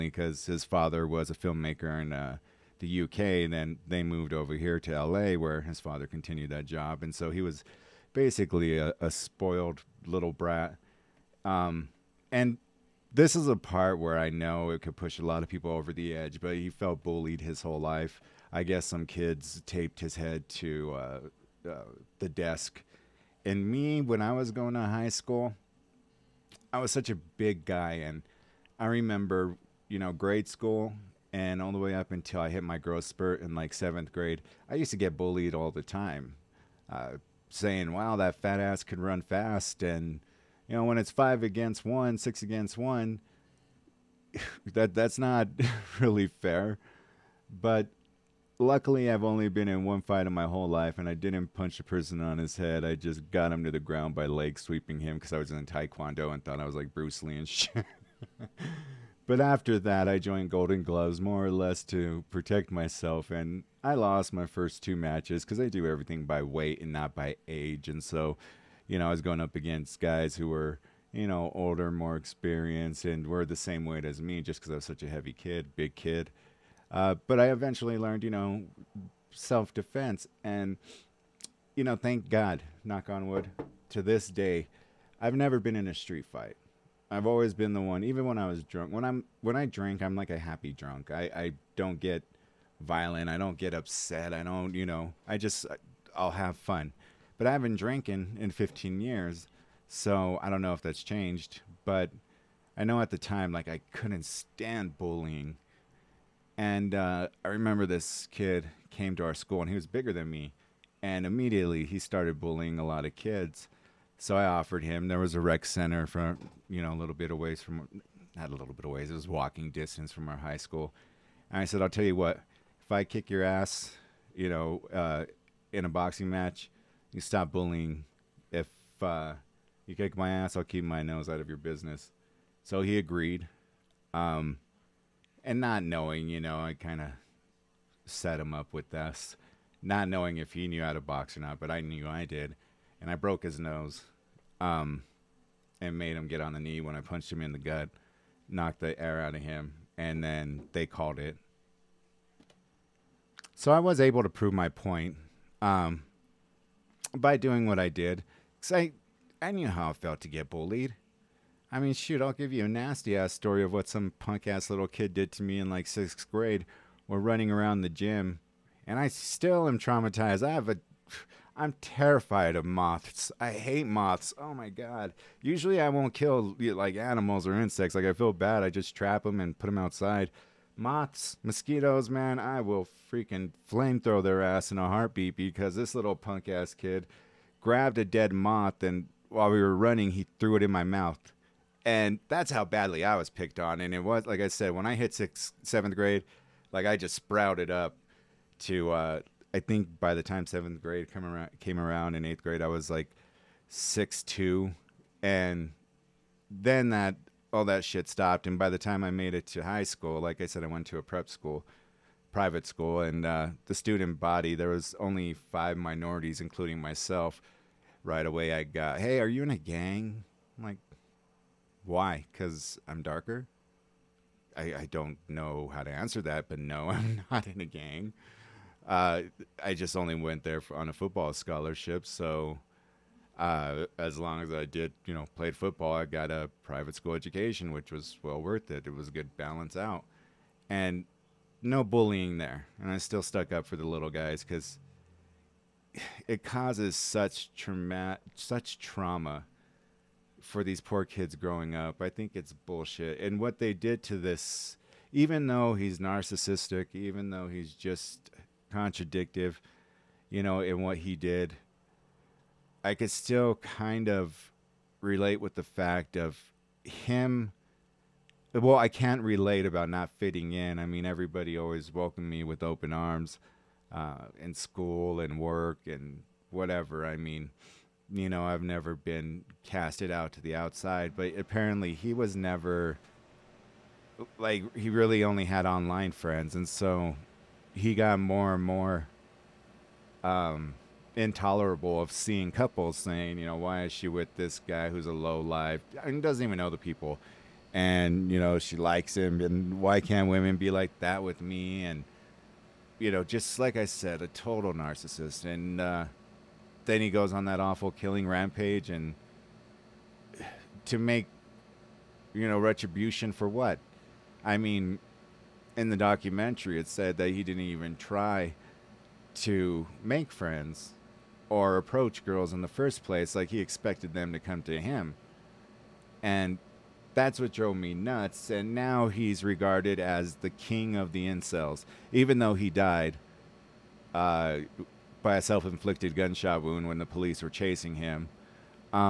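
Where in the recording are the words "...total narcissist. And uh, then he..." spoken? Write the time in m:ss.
5:04.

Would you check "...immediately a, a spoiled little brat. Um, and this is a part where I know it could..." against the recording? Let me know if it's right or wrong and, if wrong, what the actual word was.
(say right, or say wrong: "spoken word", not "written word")
wrong: "basically", not "immediately".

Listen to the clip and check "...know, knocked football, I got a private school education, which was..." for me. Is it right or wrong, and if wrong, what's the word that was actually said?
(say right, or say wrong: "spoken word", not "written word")
wrong: "played", not "knocked".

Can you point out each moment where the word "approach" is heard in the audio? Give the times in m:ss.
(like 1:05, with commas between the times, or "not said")
5:21.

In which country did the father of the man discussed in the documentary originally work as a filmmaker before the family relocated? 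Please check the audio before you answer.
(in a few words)
UK.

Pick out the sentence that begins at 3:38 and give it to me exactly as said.
Right away, I got, hey, are you in a gang?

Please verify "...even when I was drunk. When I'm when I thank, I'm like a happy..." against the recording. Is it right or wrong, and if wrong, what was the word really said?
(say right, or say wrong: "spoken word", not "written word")
wrong: "drink", not "thank".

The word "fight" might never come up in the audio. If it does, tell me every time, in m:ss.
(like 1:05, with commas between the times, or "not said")
0:50, 1:26.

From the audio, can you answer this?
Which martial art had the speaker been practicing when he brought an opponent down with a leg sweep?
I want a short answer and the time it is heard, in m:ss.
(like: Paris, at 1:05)
Taekwondo, at 0:55.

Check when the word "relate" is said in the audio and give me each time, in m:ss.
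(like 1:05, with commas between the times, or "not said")
4:25, 4:29.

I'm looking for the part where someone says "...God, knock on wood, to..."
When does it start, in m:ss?
1:22.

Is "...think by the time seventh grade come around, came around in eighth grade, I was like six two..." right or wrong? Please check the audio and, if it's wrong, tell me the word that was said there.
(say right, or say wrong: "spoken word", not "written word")
right.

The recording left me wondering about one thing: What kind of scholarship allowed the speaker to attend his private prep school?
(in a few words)
football scholarship.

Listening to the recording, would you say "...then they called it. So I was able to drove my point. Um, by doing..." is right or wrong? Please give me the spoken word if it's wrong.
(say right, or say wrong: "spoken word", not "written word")
wrong: "prove", not "drove".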